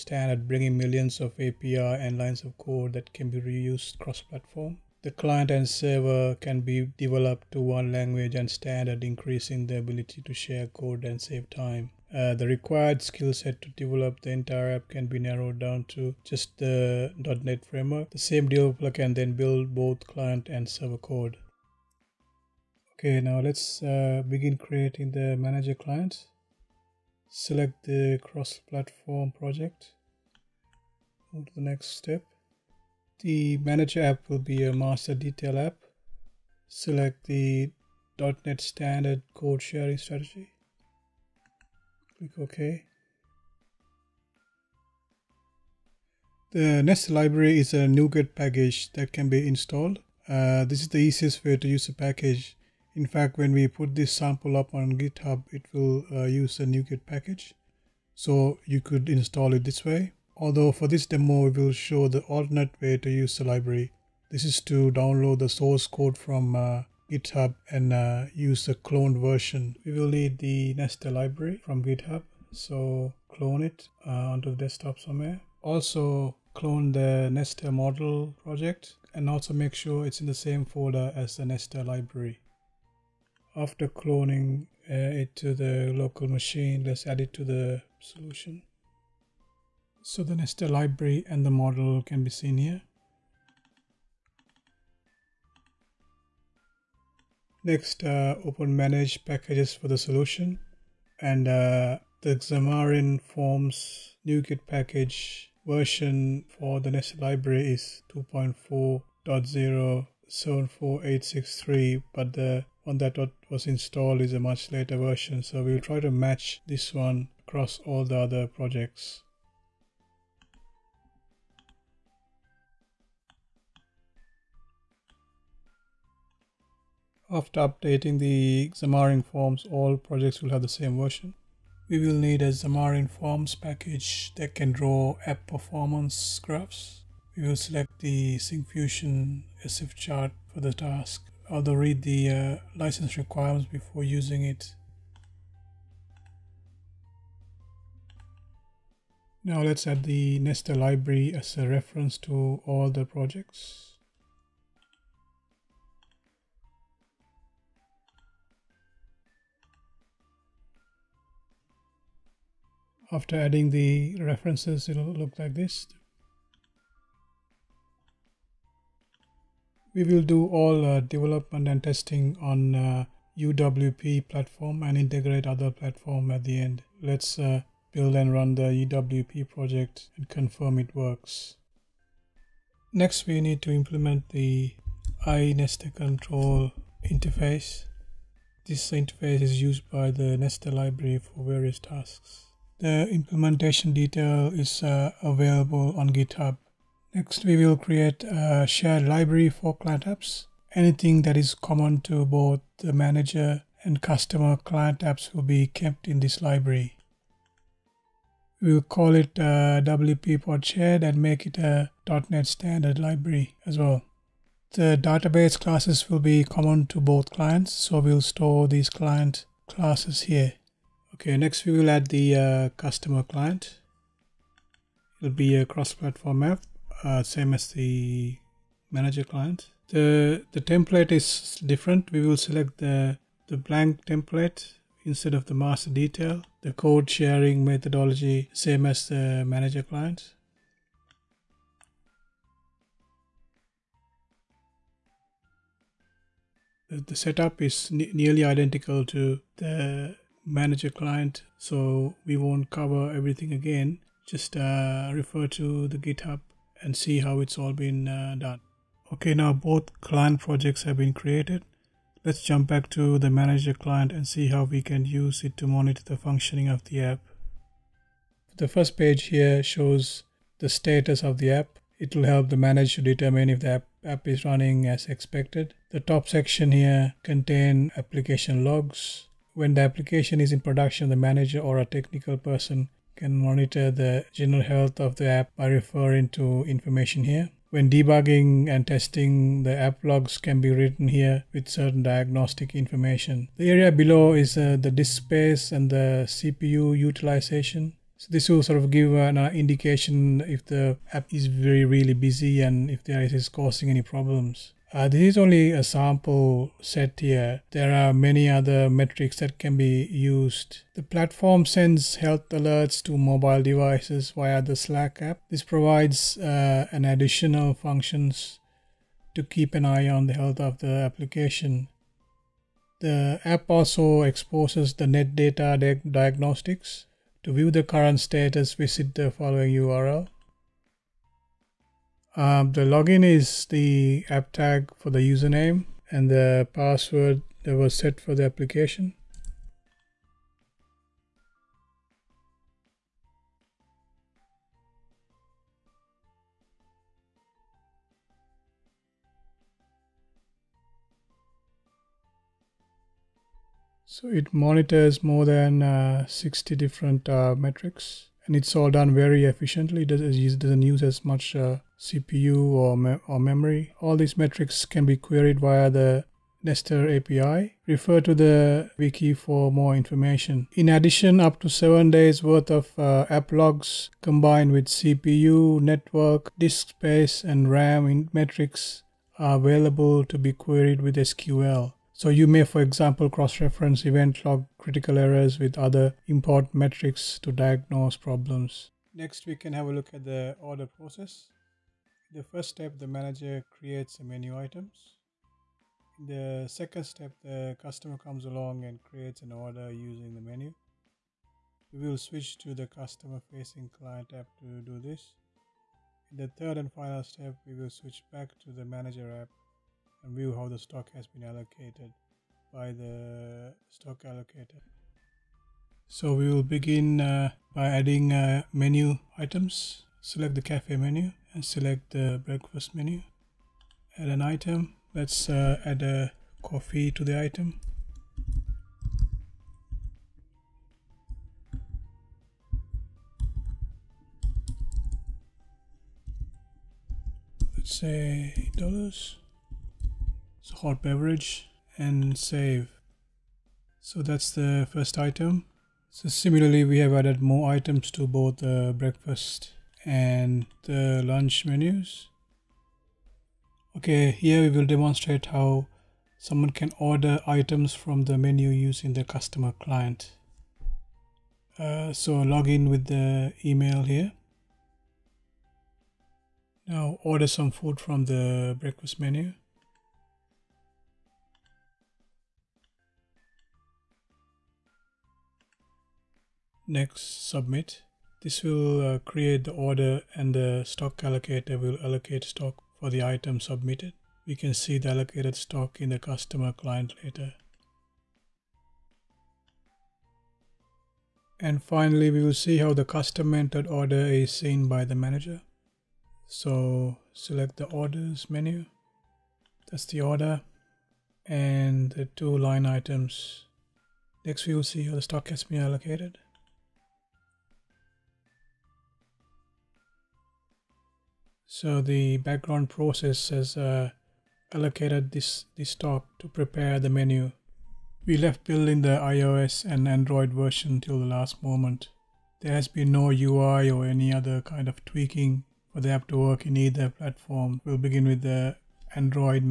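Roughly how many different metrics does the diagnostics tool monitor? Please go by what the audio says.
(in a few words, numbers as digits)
more than 60.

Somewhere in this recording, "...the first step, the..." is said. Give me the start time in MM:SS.
06:32.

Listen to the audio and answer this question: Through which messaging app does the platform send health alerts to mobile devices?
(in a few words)
Slack.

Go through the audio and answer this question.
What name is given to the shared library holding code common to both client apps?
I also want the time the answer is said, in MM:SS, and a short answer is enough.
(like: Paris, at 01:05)
WP Pod Shared, at 03:29.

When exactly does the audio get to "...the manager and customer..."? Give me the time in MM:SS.
03:22.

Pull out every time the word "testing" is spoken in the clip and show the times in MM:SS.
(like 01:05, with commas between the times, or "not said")
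02:51, 04:48.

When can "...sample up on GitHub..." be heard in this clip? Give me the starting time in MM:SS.
00:54.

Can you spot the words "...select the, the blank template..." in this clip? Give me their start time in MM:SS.
03:52.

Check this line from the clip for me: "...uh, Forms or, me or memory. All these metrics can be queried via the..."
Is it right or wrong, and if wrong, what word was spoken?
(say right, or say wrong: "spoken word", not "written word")
wrong: "CPU", not "Forms".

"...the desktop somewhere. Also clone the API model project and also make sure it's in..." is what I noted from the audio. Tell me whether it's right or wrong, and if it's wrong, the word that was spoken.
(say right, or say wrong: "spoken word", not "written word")
wrong: "Nester", not "API".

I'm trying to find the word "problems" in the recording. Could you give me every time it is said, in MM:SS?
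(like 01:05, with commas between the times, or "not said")
05:04, 06:28.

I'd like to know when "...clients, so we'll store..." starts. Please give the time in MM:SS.
03:37.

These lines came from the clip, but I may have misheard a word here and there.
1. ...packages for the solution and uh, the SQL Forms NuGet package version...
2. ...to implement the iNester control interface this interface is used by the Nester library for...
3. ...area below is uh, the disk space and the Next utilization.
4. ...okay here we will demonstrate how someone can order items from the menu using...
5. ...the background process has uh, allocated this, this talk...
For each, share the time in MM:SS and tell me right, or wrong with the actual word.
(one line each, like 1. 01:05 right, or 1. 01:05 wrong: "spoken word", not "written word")
1. 01:39 wrong: "Xamarin", not "SQL"
2. 03:03 right
3. 04:53 wrong: "CPU", not "Next"
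4. 07:33 right
5. 08:32 right.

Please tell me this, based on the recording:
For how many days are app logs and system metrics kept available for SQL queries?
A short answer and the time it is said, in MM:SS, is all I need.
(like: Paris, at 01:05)
7, at 06:11.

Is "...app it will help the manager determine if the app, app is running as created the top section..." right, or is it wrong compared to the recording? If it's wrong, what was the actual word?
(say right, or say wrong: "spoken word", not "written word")
wrong: "expected", not "created".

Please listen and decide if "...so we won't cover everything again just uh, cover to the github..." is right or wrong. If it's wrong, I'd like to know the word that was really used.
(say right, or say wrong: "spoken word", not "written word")
wrong: "refer", not "cover".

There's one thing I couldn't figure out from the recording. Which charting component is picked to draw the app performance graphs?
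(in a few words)
Syncfusion SF chart.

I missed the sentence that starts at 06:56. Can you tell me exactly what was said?
So we will begin uh, by adding uh, menu items.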